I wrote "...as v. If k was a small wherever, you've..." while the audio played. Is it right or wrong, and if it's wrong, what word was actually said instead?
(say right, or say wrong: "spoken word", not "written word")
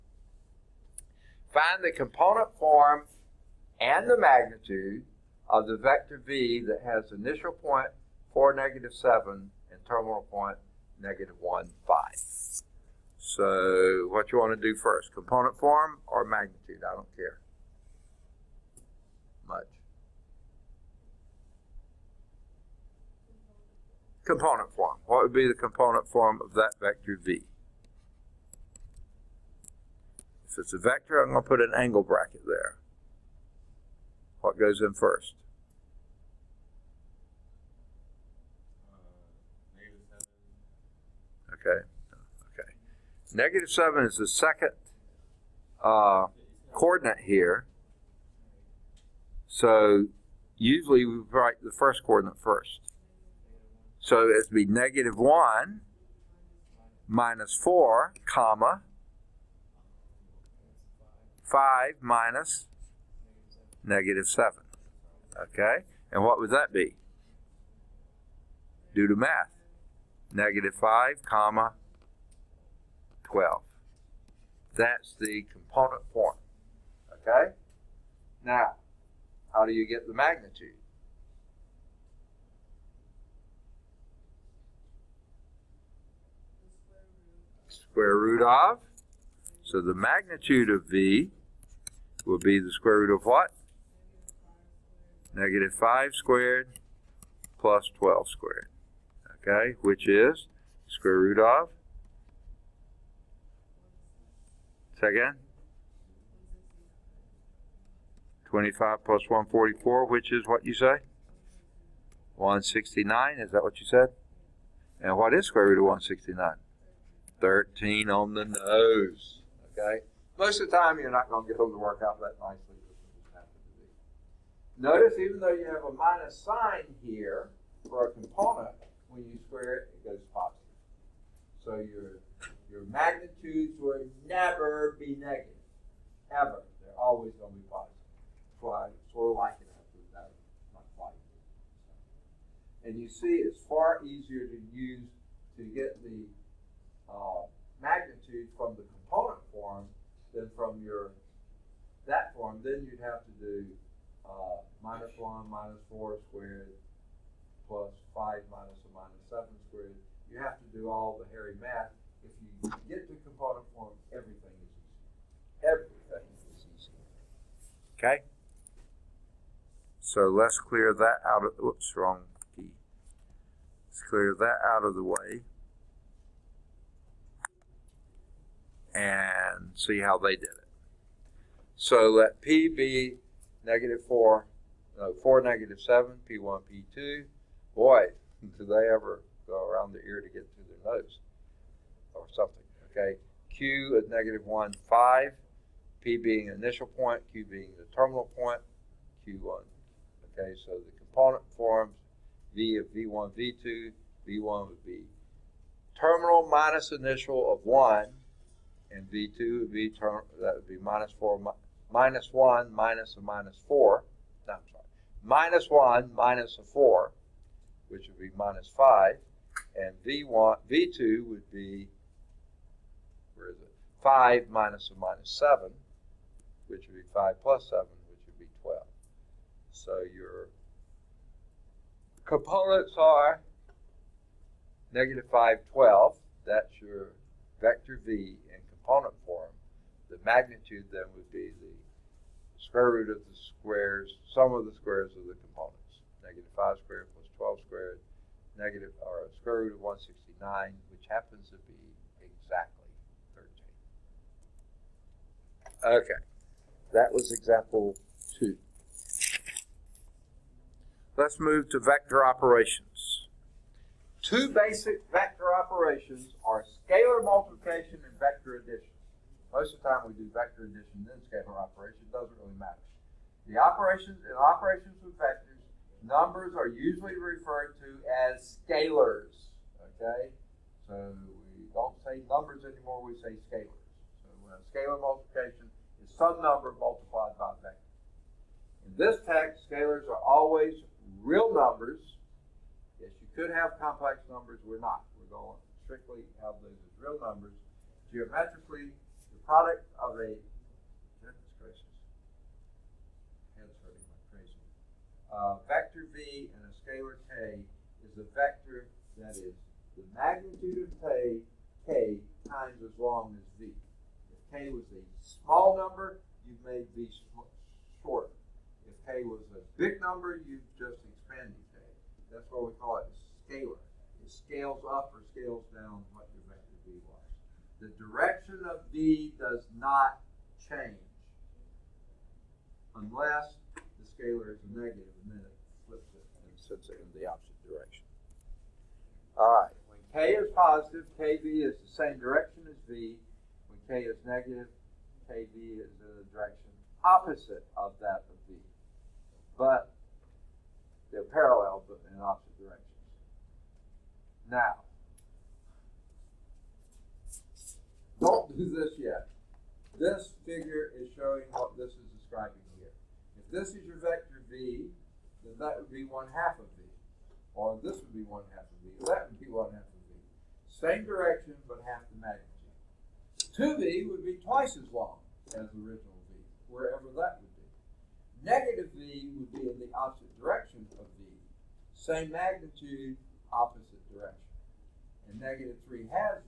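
wrong: "number", not "wherever".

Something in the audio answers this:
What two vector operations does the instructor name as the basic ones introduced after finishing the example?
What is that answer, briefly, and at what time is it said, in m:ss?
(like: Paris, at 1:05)
scalar multiplication and vector addition, at 4:26.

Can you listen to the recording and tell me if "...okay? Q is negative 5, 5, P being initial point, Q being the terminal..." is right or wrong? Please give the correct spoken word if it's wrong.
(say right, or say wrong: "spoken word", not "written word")
wrong: "1", not "5".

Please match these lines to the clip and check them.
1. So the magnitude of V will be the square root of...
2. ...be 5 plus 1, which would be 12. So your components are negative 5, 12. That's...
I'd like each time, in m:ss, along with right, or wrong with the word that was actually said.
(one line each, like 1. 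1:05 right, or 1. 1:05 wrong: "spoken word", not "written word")
1. 1:29 right
2. 3:46 wrong: "7", not "1".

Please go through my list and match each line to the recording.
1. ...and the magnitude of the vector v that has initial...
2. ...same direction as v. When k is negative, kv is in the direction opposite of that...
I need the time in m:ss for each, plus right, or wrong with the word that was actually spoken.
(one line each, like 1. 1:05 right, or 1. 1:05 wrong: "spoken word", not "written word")
1. 0:03 right
2. 5:41 right.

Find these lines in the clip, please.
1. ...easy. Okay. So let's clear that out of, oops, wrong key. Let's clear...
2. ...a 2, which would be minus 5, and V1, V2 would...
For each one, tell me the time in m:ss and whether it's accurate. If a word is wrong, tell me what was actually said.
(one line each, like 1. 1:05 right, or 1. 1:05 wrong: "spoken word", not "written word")
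1. 2:46 right
2. 3:36 wrong: "4", not "2".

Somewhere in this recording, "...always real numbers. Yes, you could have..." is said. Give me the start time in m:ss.
4:50.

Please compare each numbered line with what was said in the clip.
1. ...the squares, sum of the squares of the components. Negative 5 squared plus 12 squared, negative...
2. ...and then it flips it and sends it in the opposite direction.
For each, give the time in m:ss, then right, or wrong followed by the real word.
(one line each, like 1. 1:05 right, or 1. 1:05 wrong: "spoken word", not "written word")
1. 4:03 right
2. 5:35 right.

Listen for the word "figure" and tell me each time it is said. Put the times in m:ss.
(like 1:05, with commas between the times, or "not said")
6:00.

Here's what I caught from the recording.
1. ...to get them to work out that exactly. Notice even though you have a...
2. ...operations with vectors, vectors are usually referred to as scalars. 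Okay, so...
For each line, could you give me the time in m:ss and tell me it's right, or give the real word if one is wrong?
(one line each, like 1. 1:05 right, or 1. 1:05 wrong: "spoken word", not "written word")
1. 2:01 wrong: "nicely", not "exactly"
2. 4:34 wrong: "numbers", not "vectors".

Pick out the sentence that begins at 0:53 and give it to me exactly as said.
So it would be negative 1 minus 4, comma, 5 minus negative 7.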